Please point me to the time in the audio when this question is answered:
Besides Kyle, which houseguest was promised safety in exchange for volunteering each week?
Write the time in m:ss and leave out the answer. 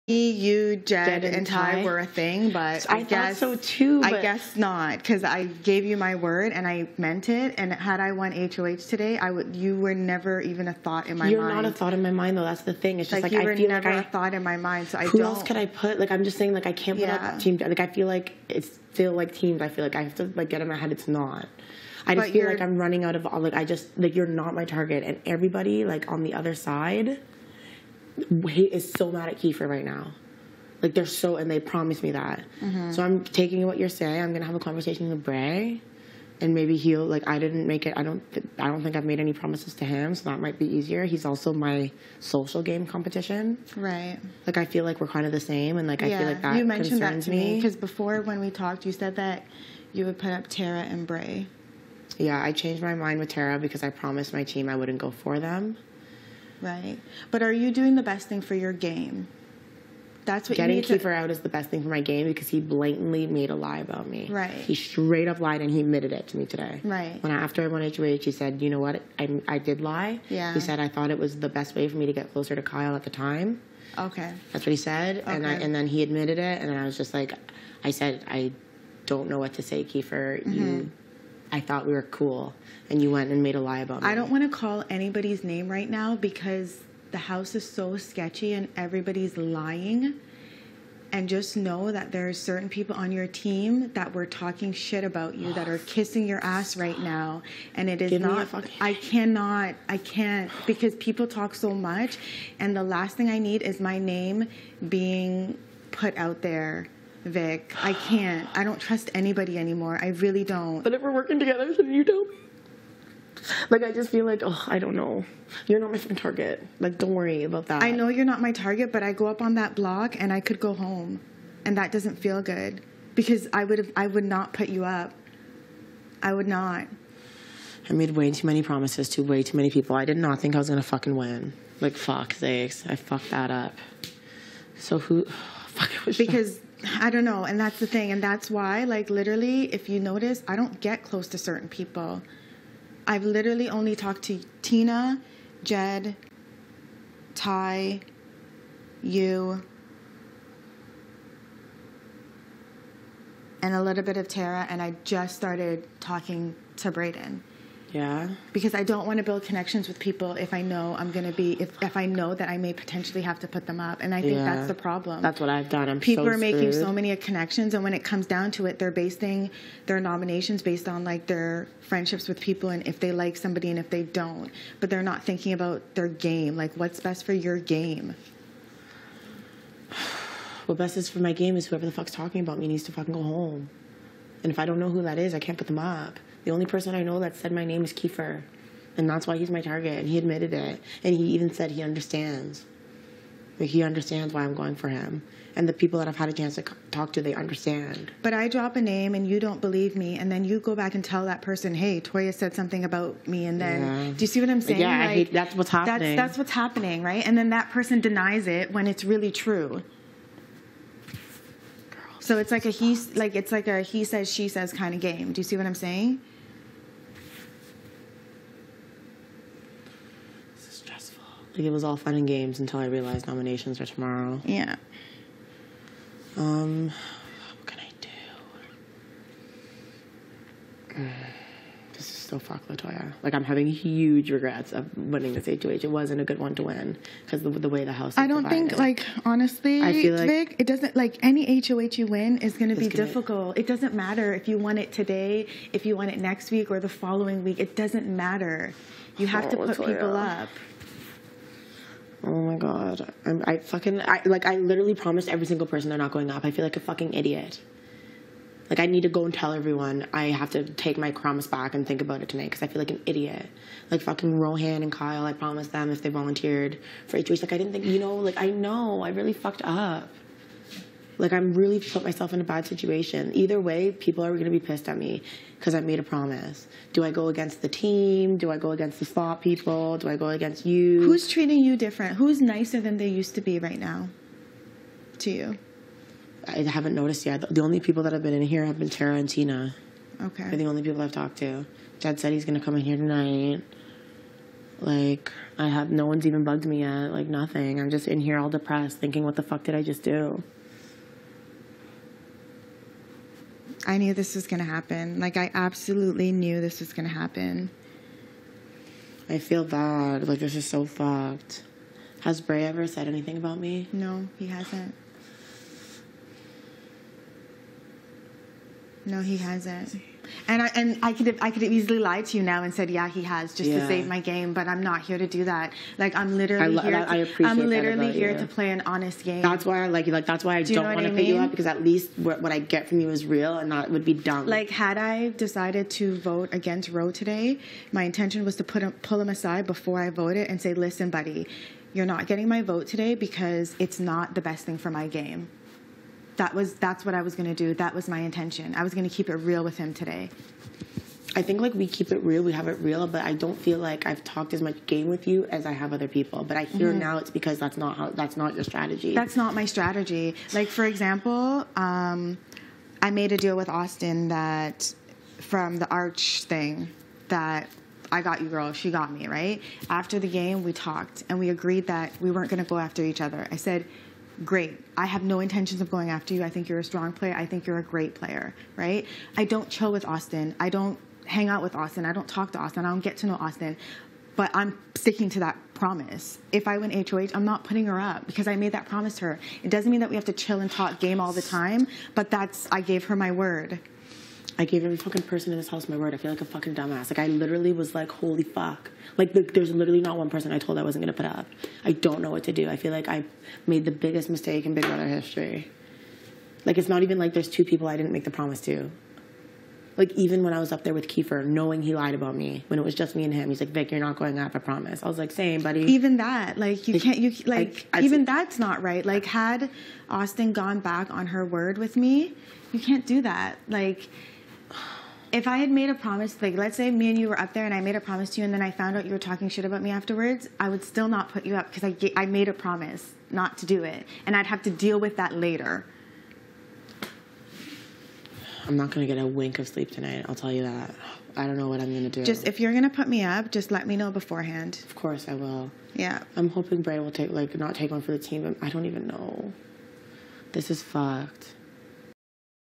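4:24.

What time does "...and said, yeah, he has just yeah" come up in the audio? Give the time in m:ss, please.
5:22.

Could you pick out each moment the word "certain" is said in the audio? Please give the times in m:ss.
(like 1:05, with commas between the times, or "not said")
1:32, 2:21.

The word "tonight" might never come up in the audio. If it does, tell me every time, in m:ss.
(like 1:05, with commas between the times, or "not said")
4:22, 4:52, 7:19.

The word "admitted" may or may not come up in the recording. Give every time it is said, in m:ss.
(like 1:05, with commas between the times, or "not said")
1:05, 1:16, 3:10.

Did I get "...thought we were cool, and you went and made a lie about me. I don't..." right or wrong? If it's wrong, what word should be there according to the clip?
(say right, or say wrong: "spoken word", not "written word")
right.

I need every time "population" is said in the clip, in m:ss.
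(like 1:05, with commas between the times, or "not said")
not said.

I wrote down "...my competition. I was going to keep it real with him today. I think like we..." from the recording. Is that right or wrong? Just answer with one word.
wrong.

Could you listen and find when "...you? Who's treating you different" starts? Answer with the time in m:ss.
4:40.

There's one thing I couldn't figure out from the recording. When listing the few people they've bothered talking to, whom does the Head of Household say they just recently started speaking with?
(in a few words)
Breydon.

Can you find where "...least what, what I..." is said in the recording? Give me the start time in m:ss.
5:31.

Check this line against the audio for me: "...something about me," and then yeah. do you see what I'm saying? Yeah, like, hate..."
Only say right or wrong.
right.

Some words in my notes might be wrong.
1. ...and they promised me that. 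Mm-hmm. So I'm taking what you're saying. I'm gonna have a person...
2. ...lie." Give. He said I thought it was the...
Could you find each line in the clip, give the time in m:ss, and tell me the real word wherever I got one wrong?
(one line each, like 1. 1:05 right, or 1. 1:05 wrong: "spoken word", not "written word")
1. 0:31 wrong: "conversation", not "person"
2. 1:09 wrong: "Yeah", not "Give".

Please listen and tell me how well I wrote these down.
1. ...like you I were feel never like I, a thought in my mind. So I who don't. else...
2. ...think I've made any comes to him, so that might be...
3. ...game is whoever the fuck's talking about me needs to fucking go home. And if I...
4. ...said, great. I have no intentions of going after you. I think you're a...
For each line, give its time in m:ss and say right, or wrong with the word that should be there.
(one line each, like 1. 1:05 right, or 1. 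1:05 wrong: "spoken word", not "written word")
1. 0:13 right
2. 0:38 wrong: "promises", not "comes"
3. 3:01 right
4. 6:13 right.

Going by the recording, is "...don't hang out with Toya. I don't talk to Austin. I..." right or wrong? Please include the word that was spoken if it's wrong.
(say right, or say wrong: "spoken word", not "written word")
wrong: "Austin", not "Toya".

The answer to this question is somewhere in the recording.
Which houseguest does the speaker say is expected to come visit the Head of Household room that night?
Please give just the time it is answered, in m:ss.
4:51.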